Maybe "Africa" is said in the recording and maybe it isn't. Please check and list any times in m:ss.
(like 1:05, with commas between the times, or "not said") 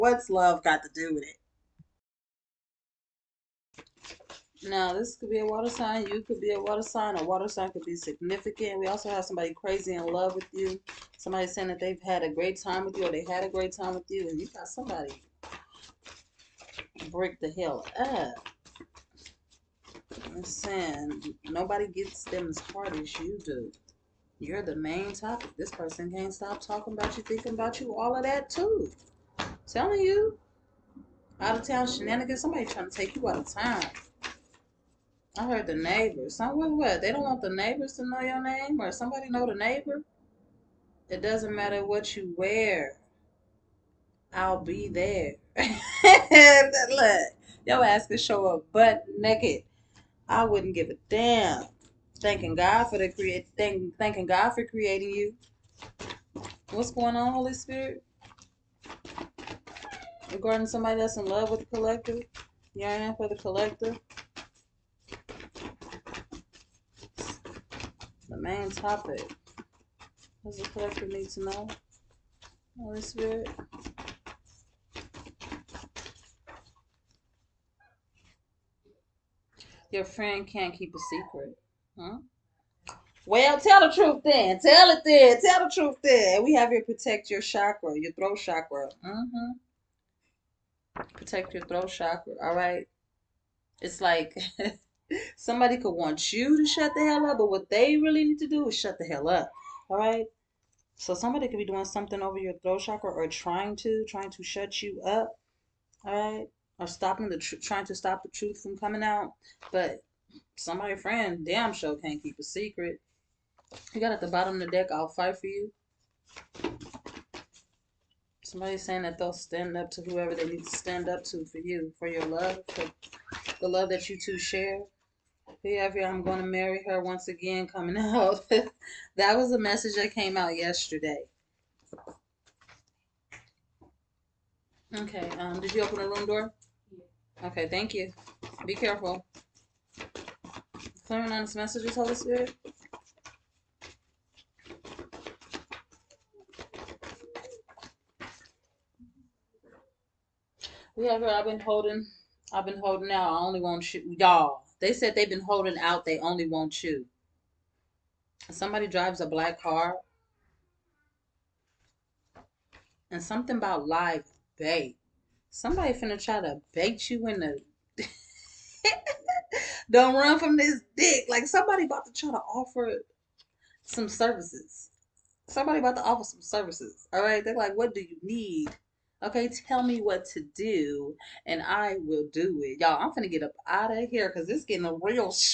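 not said.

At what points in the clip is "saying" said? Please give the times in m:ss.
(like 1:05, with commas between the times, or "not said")
0:11, 0:20, 1:58.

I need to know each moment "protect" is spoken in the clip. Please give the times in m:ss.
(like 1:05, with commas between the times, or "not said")
1:26, 1:31.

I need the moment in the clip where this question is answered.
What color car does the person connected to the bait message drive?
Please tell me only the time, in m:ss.
2:39.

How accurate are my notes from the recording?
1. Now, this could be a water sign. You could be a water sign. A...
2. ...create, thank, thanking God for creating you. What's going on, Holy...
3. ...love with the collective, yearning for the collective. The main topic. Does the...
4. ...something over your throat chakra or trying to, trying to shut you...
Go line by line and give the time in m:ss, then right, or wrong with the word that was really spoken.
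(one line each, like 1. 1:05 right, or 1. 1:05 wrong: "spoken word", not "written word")
1. 0:04 right
2. 0:53 right
3. 1:01 right
4. 1:41 right.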